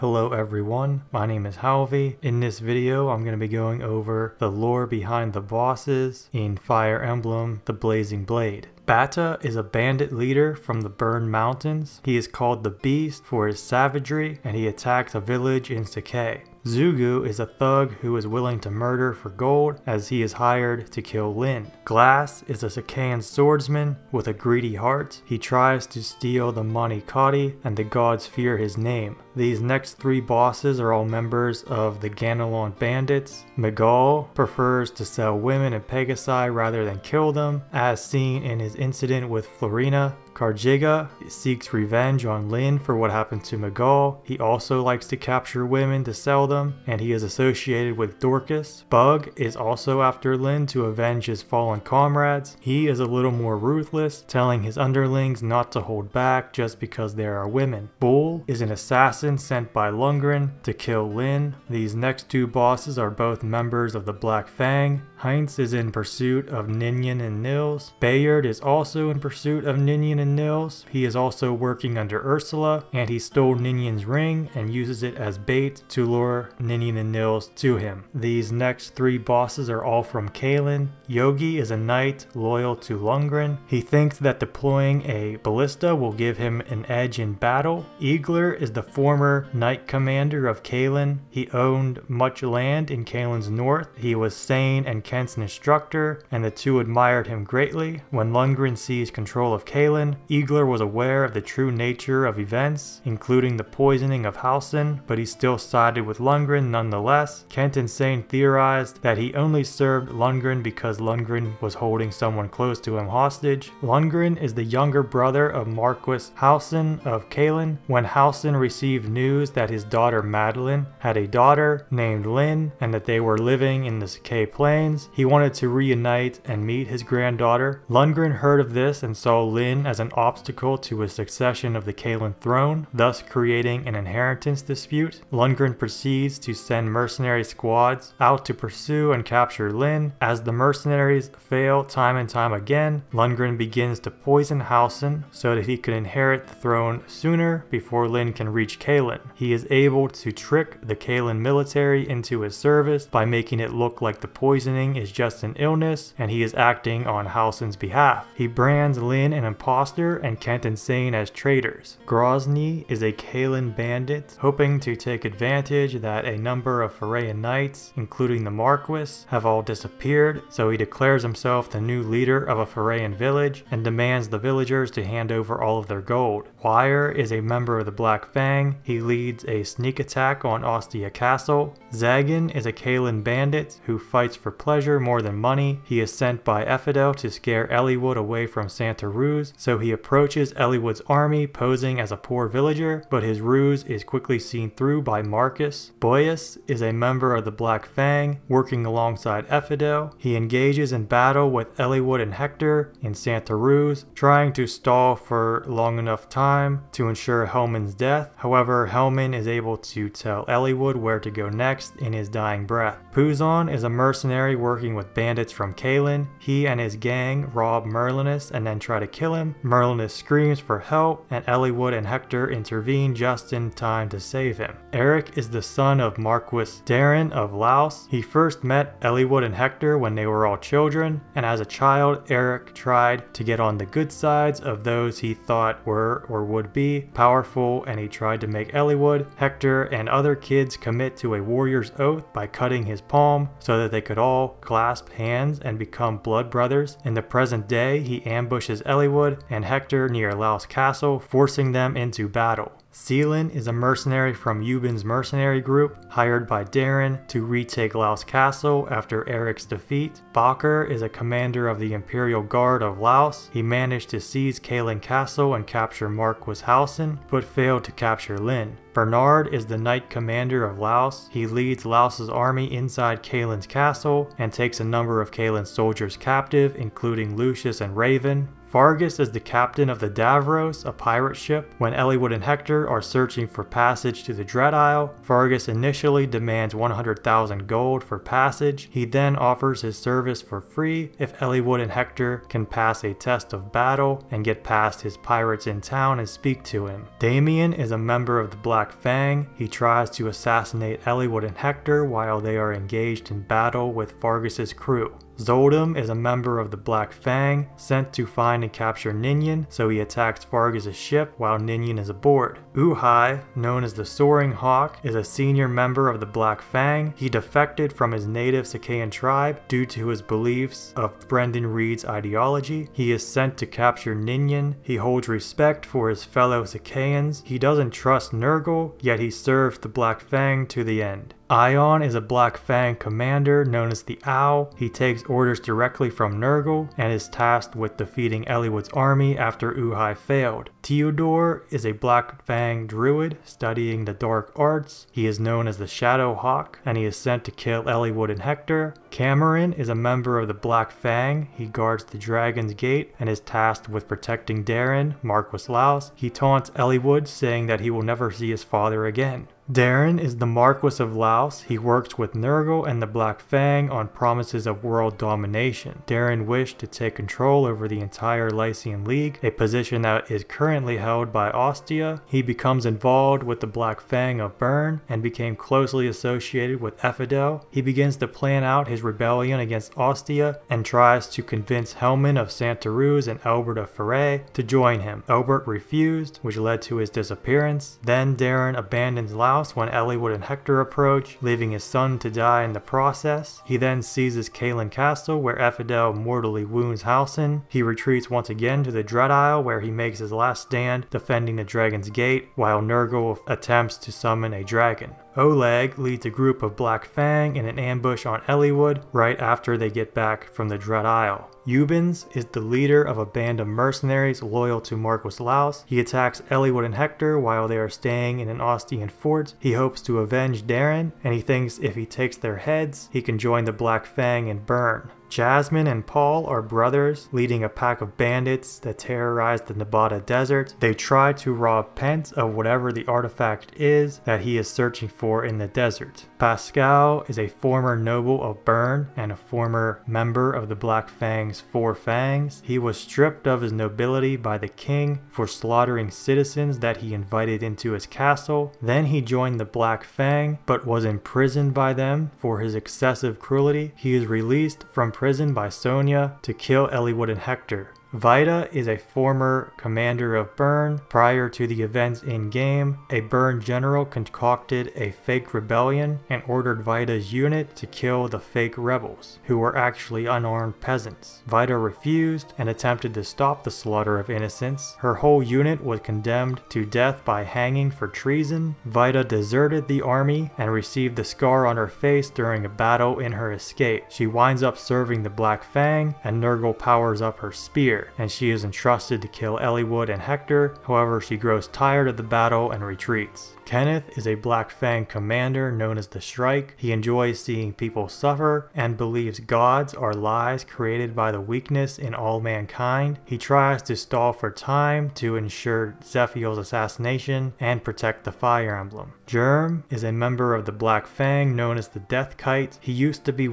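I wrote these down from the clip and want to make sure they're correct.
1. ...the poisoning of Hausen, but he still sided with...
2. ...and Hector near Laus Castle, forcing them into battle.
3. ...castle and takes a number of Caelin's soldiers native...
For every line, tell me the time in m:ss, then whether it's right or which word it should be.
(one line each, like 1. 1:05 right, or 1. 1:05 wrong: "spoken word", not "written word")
1. 1:43 right
2. 4:09 right
3. 4:33 wrong: "captive", not "native".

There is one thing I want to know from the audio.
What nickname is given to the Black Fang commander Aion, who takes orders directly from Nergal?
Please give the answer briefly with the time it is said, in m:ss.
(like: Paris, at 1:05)
the Owl, at 5:34.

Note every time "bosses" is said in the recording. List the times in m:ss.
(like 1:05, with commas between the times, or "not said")
0:05, 0:30, 1:02, 1:19.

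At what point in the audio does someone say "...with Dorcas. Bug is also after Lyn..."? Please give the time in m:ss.
0:47.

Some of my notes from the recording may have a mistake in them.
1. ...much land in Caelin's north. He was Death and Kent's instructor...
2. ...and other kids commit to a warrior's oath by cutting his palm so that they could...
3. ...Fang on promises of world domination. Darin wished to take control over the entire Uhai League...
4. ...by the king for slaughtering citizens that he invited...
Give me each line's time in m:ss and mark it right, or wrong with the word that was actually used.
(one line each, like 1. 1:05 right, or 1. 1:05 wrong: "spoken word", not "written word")
1. 1:32 wrong: "Sain", not "Death"
2. 3:59 right
3. 6:03 wrong: "Lycian", not "Uhai"
4. 7:24 right.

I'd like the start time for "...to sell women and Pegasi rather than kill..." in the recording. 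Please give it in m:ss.
0:34.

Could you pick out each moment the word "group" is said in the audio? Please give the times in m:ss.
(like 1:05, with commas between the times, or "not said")
4:15, 6:46.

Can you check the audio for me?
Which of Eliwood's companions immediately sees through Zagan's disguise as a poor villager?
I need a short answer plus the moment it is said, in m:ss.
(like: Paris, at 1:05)
Marcus, at 3:15.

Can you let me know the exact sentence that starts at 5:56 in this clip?
He taunts Eliwood saying that he will never see his father again.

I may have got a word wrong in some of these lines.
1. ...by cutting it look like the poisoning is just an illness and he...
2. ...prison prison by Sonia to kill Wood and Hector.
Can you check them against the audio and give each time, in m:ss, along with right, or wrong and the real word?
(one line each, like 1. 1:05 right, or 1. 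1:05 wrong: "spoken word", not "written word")
1. 2:33 wrong: "making", not "cutting"
2. 7:35 right.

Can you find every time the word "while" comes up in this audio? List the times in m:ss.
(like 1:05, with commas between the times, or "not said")
5:02, 5:11, 6:42, 6:57.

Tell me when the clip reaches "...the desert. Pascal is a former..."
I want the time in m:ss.
7:15.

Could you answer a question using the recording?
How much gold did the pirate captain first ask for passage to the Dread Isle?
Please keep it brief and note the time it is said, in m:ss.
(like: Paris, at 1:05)
100,000 gold, at 4:46.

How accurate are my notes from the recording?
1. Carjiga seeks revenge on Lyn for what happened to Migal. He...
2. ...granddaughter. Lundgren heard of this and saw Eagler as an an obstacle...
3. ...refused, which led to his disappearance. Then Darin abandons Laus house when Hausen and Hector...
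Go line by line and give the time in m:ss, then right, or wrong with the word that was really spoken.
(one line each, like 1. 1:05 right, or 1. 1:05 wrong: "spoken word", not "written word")
1. 0:40 right
2. 2:07 wrong: "Lyn", not "Eagler"
3. 6:25 wrong: "Eliwood", not "Hausen".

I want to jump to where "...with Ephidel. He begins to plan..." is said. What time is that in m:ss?
6:16.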